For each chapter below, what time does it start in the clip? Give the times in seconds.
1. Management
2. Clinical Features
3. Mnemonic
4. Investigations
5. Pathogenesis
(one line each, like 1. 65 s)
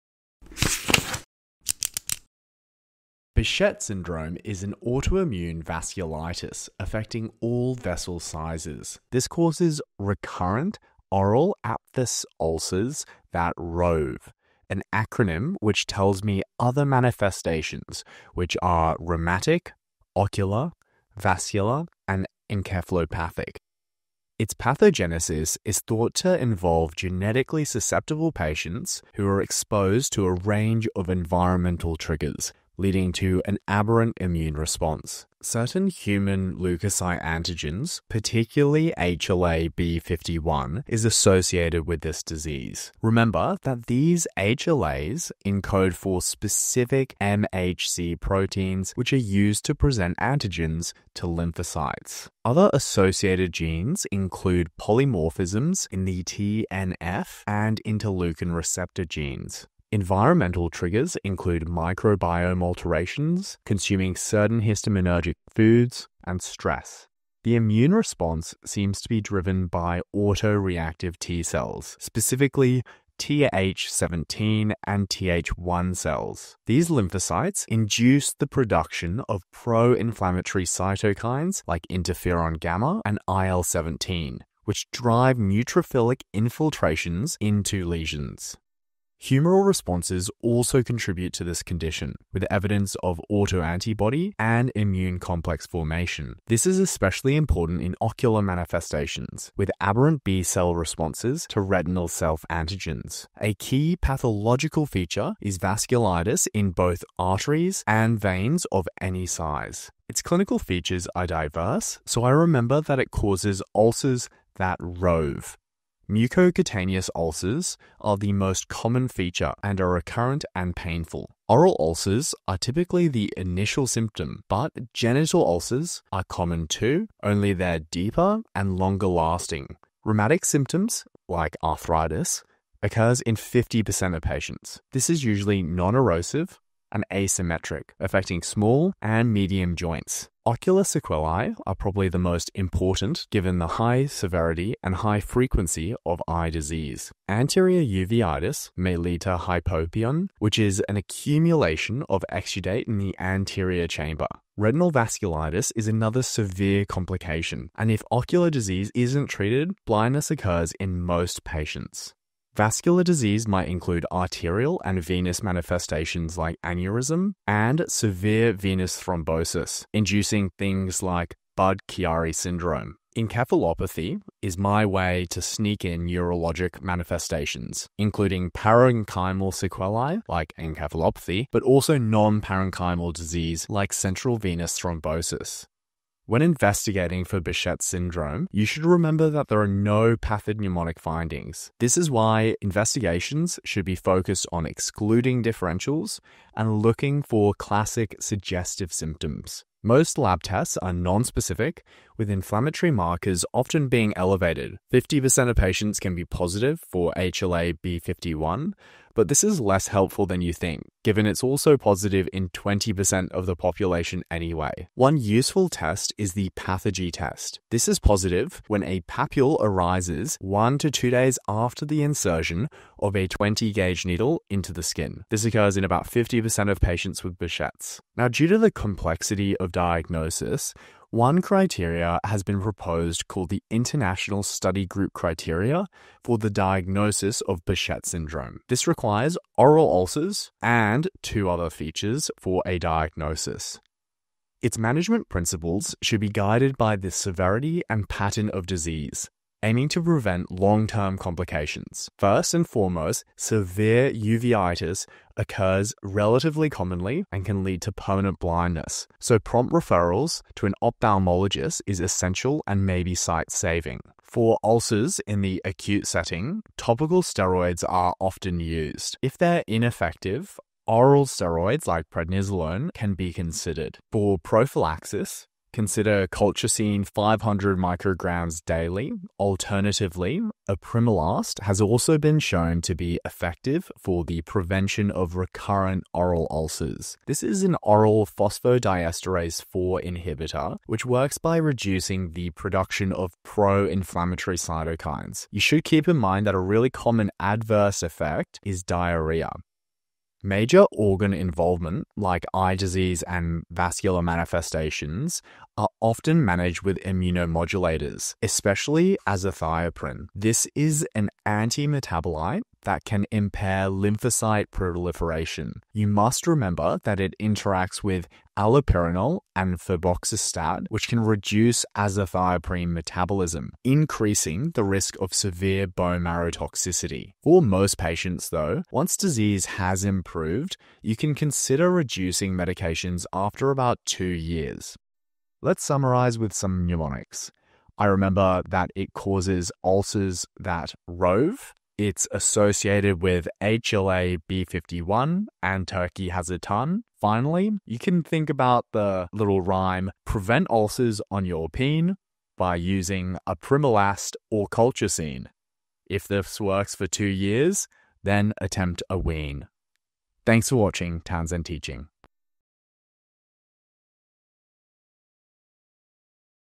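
1. 244 s
2. 110 s
3. 335 s
4. 185 s
5. 24 s.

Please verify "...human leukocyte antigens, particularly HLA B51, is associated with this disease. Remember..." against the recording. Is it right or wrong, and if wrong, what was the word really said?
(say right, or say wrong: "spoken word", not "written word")
right.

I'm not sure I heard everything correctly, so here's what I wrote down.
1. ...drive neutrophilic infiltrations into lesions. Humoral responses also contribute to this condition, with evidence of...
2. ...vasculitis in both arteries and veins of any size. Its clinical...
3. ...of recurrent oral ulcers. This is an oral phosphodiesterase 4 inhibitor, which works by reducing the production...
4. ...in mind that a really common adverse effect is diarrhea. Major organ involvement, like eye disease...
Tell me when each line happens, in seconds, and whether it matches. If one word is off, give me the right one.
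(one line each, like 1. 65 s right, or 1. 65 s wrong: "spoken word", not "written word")
1. 84 s right
2. 105 s right
3. 285 s right
4. 296 s right.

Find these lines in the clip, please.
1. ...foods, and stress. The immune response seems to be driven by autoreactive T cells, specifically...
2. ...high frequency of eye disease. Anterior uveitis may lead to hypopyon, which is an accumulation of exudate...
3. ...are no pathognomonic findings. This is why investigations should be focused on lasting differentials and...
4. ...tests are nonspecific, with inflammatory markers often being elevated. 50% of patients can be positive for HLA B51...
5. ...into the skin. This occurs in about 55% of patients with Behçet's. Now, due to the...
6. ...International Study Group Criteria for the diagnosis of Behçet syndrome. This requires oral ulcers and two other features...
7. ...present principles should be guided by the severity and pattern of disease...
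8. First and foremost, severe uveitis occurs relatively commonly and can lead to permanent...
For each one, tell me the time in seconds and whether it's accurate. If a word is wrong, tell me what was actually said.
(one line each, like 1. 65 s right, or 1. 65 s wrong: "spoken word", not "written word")
1. 65 s right
2. 144 s right
3. 189 s wrong: "excluding", not "lasting"
4. 200 s right
5. 224 s wrong: "50", not "55"
6. 233 s right
7. 244 s wrong: "management", not "present"
8. 252 s right.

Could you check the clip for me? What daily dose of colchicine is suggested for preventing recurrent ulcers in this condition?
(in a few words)
500 micrograms.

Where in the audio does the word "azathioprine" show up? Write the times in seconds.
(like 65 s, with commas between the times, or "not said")
309 s, 321 s.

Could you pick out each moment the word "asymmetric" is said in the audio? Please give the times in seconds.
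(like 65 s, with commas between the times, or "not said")
137 s.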